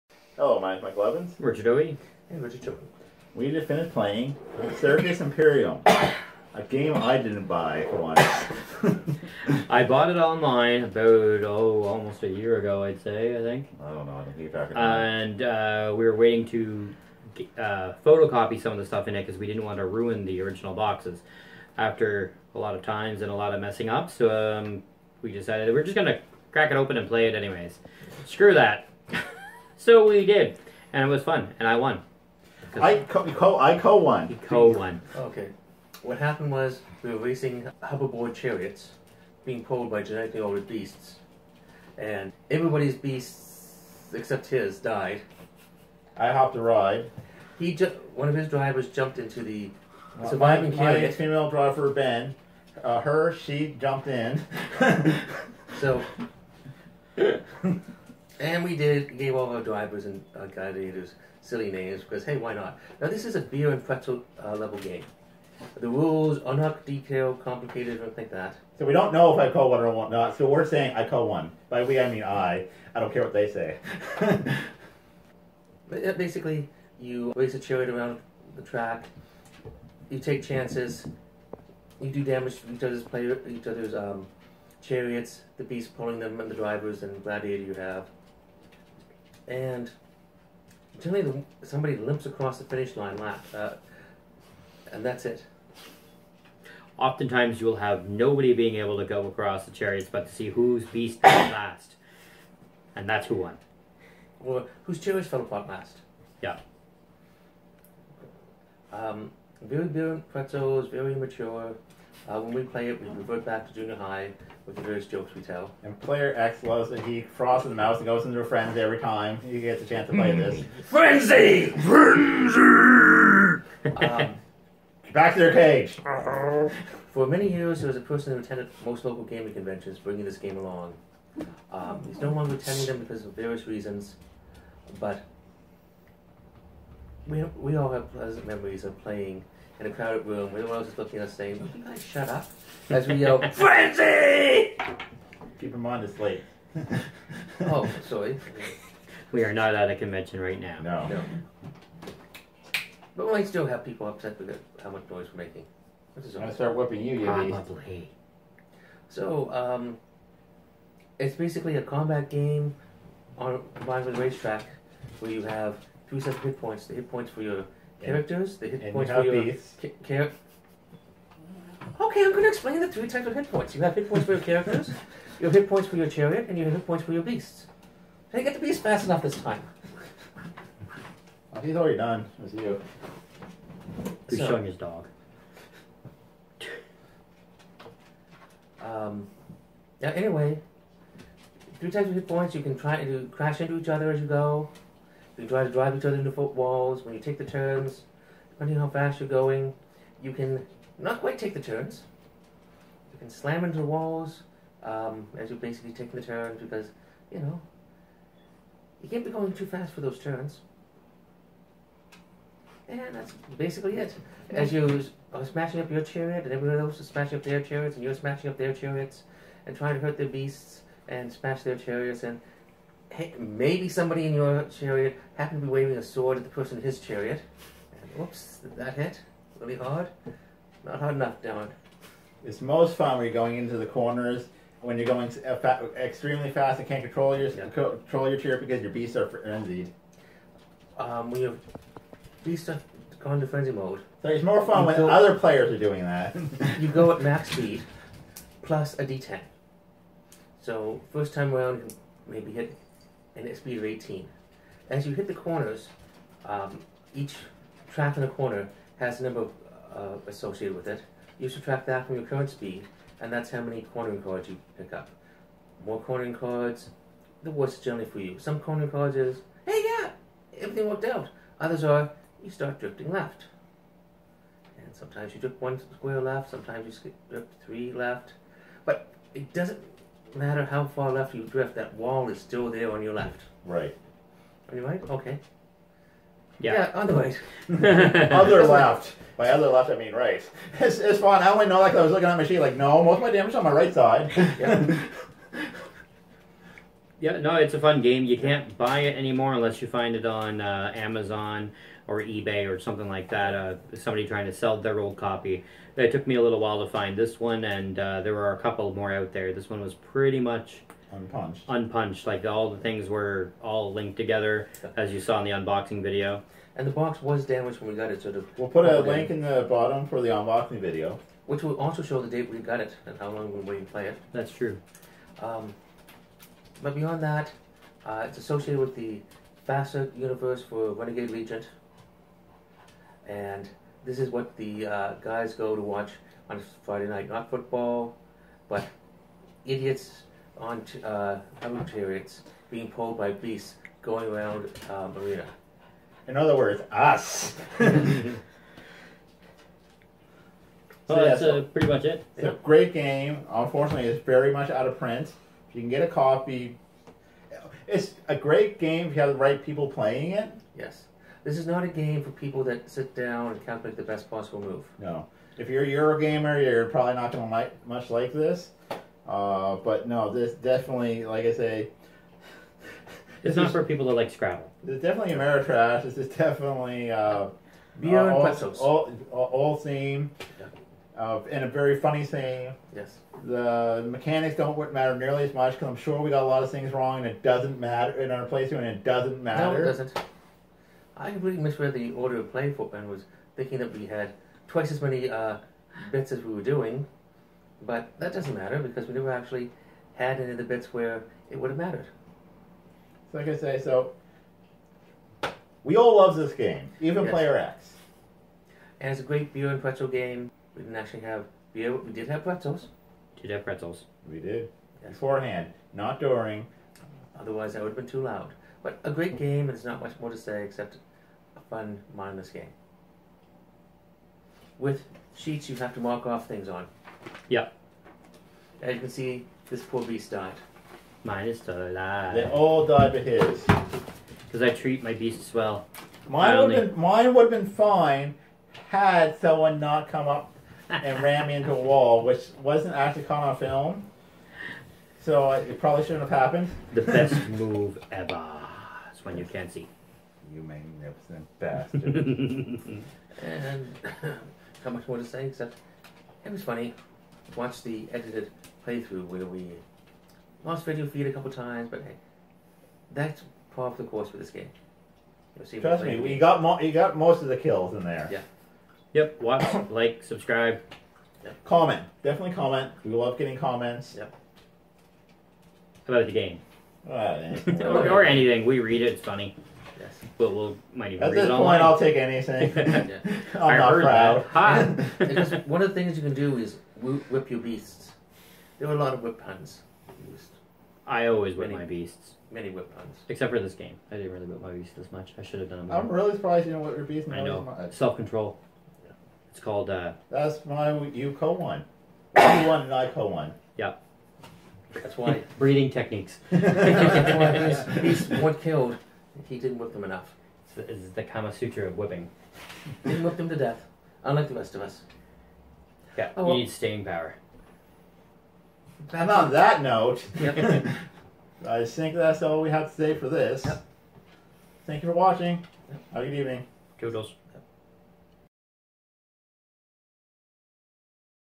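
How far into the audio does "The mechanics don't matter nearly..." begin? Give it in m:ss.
6:23.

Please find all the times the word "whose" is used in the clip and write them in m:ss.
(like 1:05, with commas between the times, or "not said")
1:40, 1:44.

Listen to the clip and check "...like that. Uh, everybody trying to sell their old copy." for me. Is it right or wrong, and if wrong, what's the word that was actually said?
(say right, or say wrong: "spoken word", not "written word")
wrong: "somebody", not "everybody".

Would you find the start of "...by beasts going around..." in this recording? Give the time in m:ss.
5:43.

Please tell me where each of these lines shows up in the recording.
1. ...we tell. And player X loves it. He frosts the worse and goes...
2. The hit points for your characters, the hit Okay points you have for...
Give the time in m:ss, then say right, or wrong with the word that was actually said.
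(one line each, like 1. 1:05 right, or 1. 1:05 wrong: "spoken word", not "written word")
1. 1:55 wrong: "mouse", not "worse"
2. 2:46 wrong: "And", not "Okay".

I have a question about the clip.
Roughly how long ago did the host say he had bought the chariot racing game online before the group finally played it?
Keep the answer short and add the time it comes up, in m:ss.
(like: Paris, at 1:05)
almost a year ago, at 0:11.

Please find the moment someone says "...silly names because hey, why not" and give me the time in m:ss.
1:01.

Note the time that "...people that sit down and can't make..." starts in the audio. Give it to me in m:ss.
6:02.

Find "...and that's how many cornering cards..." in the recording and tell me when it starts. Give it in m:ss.
4:23.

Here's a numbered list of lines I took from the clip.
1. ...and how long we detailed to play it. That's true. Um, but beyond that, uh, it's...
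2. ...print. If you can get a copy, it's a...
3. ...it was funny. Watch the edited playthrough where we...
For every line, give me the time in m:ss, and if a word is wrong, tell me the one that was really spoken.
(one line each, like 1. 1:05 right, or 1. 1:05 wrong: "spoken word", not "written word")
1. 5:23 wrong: "waited", not "detailed"
2. 5:54 right
3. 7:36 right.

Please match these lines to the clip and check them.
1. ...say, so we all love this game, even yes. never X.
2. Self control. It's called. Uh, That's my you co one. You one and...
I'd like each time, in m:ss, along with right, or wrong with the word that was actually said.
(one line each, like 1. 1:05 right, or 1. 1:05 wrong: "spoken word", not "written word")
1. 6:43 wrong: "player", not "never"
2. 8:17 right.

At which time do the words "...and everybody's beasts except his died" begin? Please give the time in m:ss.
0:41.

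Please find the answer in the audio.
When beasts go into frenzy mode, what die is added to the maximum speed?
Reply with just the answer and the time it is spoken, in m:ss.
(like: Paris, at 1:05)
d10, at 4:09.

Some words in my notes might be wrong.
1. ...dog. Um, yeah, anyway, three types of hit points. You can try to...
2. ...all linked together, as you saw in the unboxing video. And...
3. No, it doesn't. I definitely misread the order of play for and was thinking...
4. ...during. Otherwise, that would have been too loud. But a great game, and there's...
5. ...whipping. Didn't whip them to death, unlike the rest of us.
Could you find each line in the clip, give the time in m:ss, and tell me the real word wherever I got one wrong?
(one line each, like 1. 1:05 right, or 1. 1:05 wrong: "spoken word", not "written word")
1. 3:04 right
2. 5:13 right
3. 6:29 wrong: "completely", not "definitely"
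4. 6:56 right
5. 8:31 right.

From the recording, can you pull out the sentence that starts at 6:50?
We didn't actually have we, we did have pretzels.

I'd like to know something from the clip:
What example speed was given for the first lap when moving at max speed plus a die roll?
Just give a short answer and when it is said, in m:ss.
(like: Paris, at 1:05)
18, at 4:13.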